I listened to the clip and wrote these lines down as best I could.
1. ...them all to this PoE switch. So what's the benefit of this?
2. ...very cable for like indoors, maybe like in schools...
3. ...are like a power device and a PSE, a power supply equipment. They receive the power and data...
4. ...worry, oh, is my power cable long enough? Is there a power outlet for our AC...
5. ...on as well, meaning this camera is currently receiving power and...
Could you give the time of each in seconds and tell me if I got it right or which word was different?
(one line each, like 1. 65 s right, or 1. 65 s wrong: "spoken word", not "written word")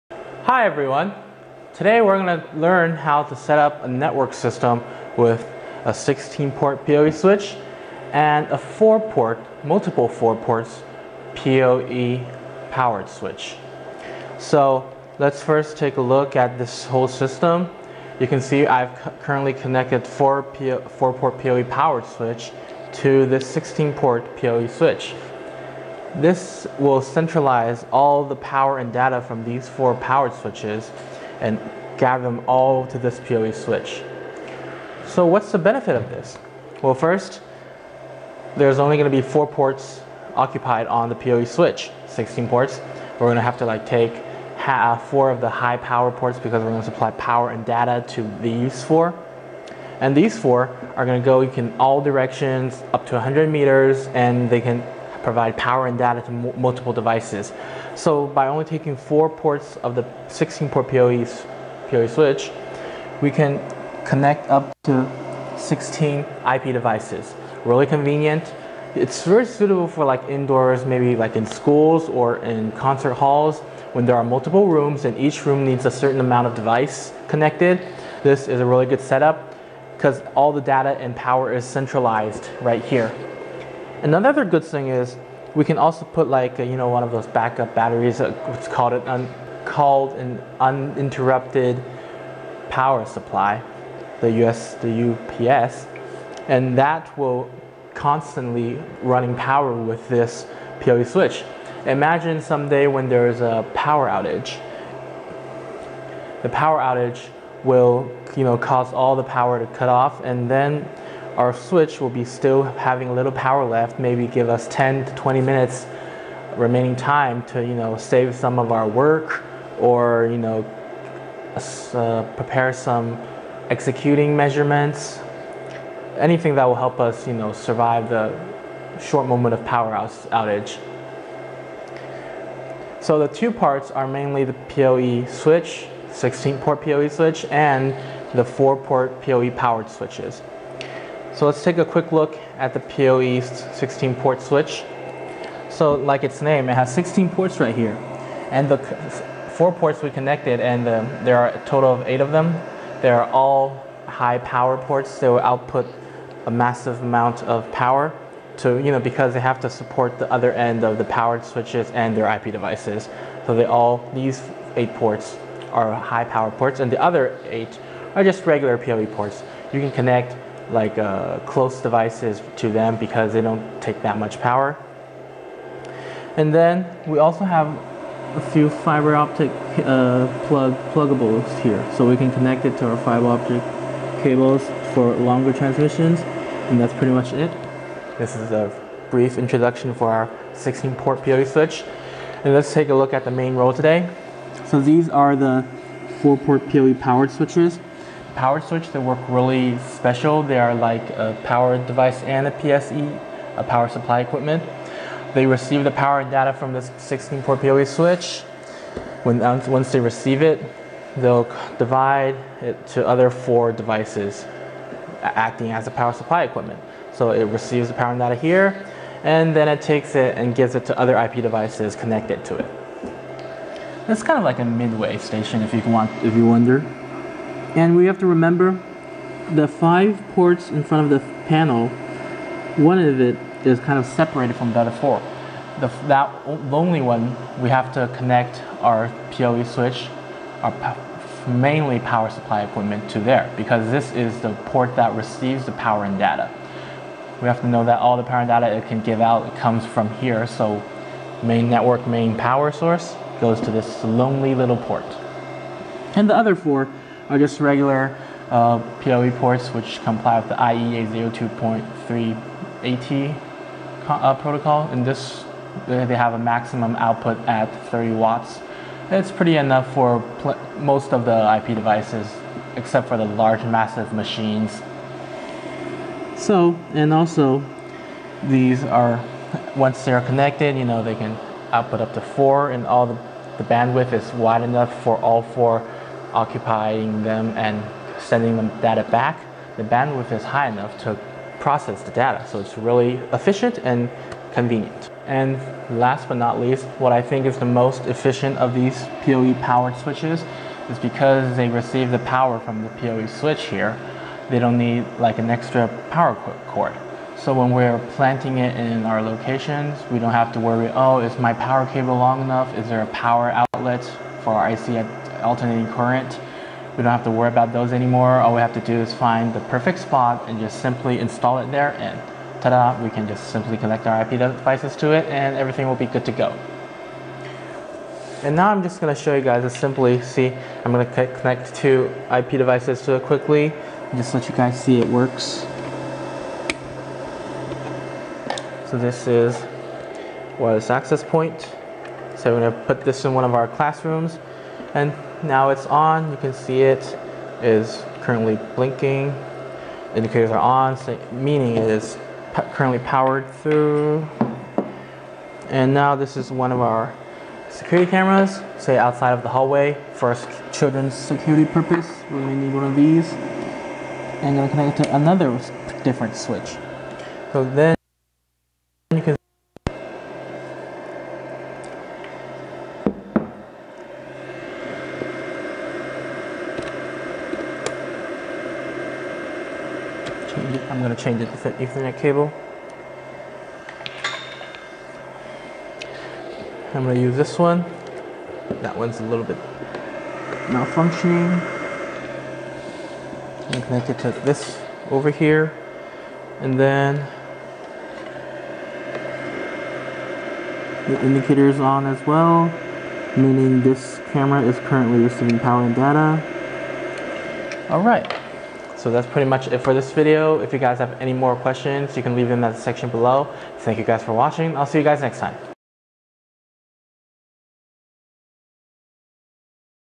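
1. 32 s right
2. 69 s wrong: "suitable", not "cable"
3. 200 s right
4. 310 s right
5. 401 s right.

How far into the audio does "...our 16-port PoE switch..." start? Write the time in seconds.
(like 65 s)
190 s.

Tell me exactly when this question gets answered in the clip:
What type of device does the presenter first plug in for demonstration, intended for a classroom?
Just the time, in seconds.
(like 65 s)
340 s.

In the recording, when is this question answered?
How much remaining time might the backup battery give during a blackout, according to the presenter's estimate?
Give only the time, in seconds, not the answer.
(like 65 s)
114 s.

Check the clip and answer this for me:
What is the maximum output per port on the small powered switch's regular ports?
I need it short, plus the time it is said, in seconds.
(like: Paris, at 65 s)
30 watts, at 267 s.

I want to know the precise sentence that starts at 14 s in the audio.
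So let's first take a look at this whole system.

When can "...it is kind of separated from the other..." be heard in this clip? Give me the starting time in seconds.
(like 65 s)
233 s.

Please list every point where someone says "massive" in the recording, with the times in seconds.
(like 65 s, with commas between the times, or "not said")
156 s, 273 s.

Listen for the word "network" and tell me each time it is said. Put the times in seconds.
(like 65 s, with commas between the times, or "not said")
3 s, 251 s.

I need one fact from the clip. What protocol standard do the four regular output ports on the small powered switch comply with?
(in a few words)
IEEE 802.3at.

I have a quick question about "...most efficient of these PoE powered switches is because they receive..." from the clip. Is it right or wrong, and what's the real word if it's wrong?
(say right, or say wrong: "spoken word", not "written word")
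right.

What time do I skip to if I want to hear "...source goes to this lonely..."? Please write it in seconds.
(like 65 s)
252 s.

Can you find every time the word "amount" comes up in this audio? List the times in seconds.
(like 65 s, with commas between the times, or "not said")
76 s, 157 s.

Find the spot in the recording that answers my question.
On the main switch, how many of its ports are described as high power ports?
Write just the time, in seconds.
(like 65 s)
151 s.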